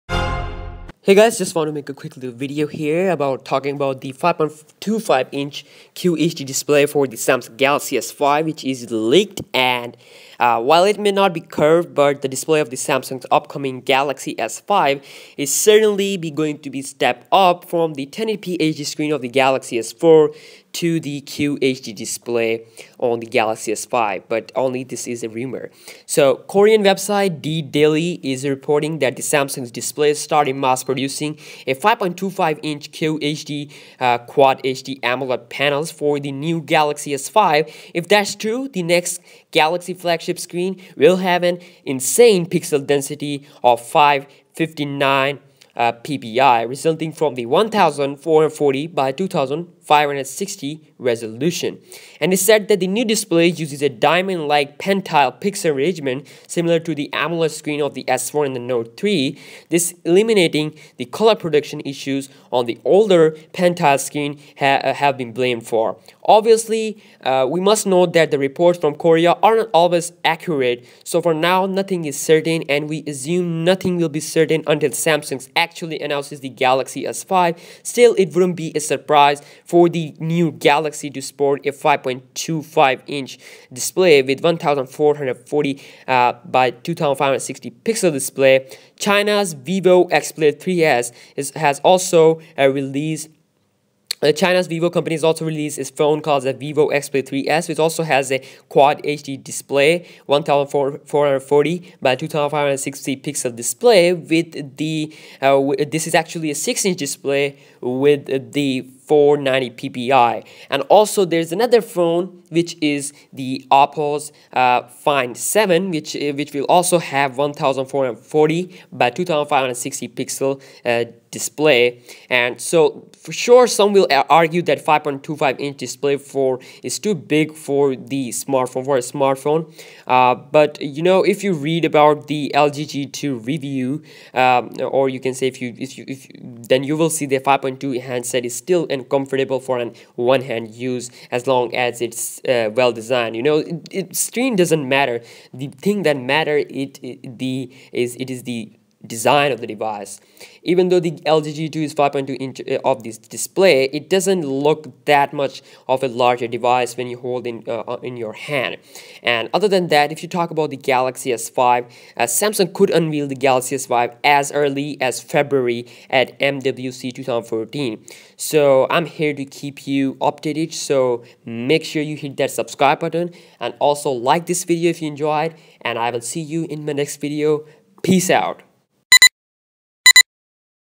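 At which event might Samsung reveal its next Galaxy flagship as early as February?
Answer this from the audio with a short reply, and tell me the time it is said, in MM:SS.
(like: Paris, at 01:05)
MWC 2014, at 02:46.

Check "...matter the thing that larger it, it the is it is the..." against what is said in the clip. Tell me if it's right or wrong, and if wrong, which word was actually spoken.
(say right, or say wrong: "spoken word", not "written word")
wrong: "matter", not "larger".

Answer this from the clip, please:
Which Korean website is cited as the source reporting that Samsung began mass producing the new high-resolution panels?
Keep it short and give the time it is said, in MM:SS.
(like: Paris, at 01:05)
D Daily, at 00:27.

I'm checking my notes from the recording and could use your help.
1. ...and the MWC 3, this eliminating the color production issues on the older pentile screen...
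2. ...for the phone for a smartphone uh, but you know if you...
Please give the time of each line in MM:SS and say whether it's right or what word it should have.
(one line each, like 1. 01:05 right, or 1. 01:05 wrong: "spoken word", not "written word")
1. 00:58 wrong: "Note", not "MWC"
2. 02:07 wrong: "smartphone", not "phone".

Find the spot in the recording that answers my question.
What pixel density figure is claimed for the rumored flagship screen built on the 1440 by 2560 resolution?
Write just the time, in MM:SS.
00:43.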